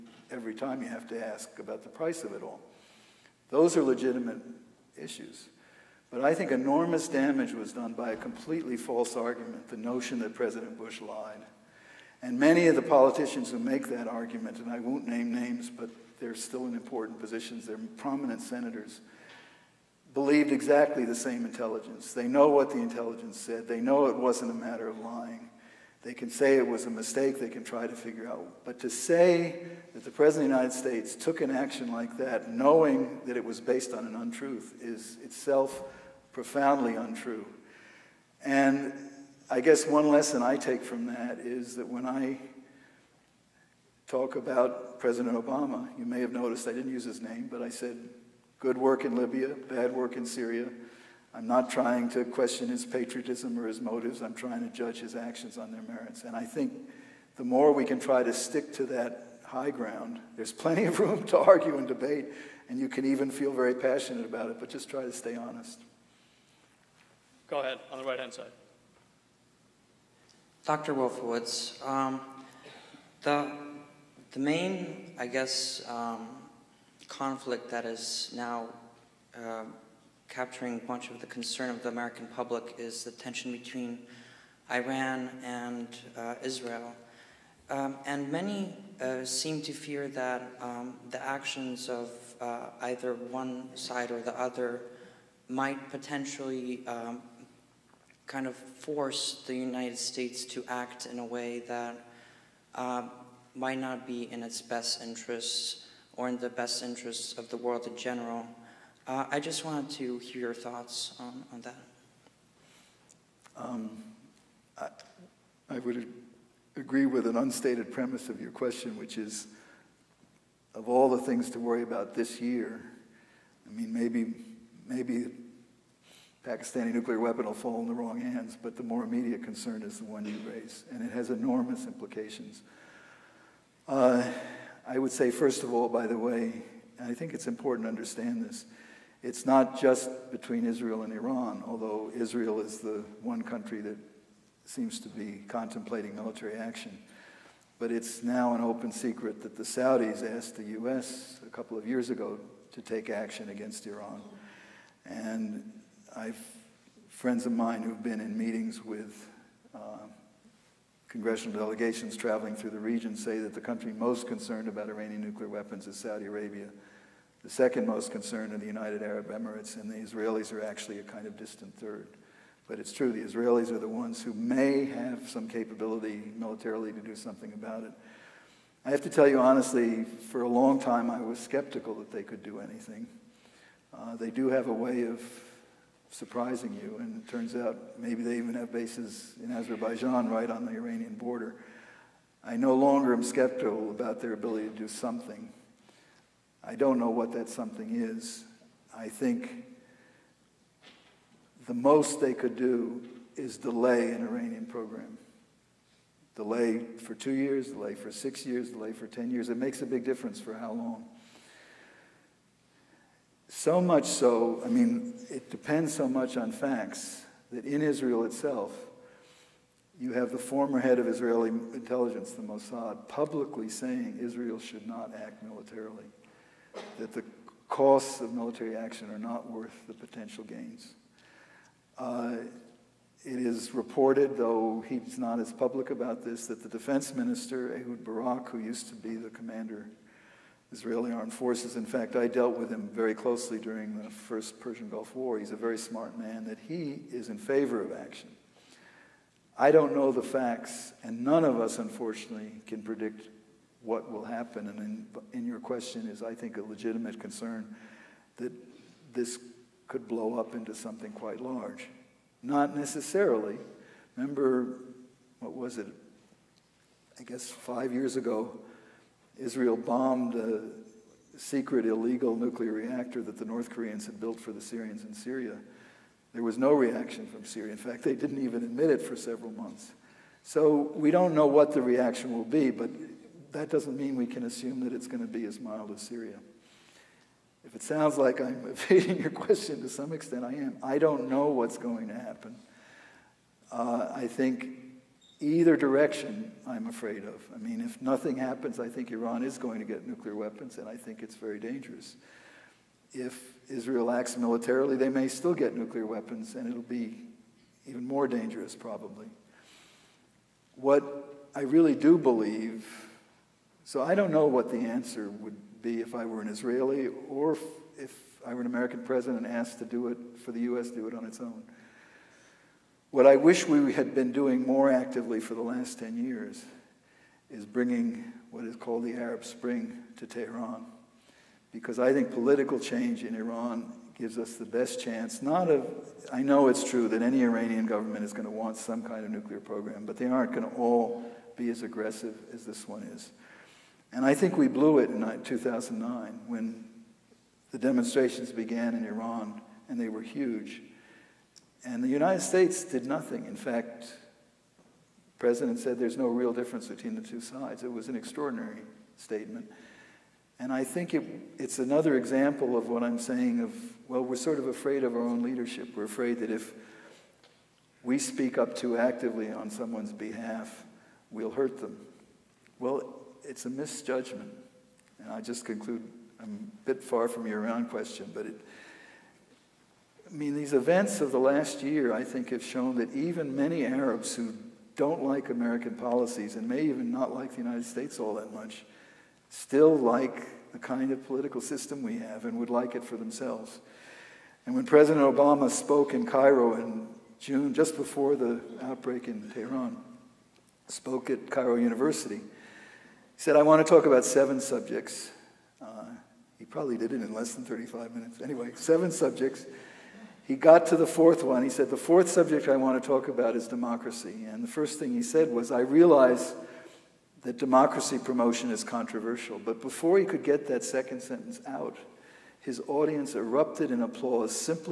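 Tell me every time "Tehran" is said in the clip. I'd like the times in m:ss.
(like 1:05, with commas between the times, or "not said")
5:30, 6:39.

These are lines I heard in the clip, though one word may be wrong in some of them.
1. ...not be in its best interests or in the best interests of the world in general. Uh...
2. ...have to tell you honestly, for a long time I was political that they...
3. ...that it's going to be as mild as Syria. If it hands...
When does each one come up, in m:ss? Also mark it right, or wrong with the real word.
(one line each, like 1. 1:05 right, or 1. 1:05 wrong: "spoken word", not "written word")
1. 1:43 right
2. 2:58 wrong: "skeptical", not "political"
3. 4:44 wrong: "sounds", not "hands".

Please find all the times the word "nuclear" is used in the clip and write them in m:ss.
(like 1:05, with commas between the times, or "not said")
2:06, 2:45, 4:32, 5:00, 5:05, 5:39.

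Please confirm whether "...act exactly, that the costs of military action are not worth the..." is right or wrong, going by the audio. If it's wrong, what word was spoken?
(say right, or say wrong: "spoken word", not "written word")
wrong: "militarily", not "exactly".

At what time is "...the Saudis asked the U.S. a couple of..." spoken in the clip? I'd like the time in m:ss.
2:29.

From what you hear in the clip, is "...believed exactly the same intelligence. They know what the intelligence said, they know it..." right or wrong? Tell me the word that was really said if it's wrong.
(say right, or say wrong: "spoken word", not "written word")
right.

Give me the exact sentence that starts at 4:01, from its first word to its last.
In fact, I dealt with him very closely during the first Persian Gulf War.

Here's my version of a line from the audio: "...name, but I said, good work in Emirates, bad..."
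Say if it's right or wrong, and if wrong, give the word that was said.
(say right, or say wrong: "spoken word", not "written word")
wrong: "Libya", not "Emirates".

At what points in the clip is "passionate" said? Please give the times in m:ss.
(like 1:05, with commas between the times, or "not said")
1:03.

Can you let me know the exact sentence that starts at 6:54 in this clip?
And the first thing he said was, I realize that democracy promotion is controversial.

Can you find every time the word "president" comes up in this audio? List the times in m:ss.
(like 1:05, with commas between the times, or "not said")
0:10, 0:30, 0:44, 5:19, 5:55, 6:34.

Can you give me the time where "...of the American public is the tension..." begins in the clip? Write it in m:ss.
1:21.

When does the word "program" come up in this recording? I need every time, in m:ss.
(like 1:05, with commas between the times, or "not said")
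3:24, 5:39.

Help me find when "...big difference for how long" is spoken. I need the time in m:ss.
3:29.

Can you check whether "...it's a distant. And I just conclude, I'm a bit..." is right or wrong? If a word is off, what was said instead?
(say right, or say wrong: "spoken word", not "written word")
wrong: "misjudgment", not "distant".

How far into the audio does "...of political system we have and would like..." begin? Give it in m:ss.
6:31.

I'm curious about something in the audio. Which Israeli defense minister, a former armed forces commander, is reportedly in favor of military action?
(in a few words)
Ehud Barak.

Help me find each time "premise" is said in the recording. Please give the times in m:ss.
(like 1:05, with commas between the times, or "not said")
1:57.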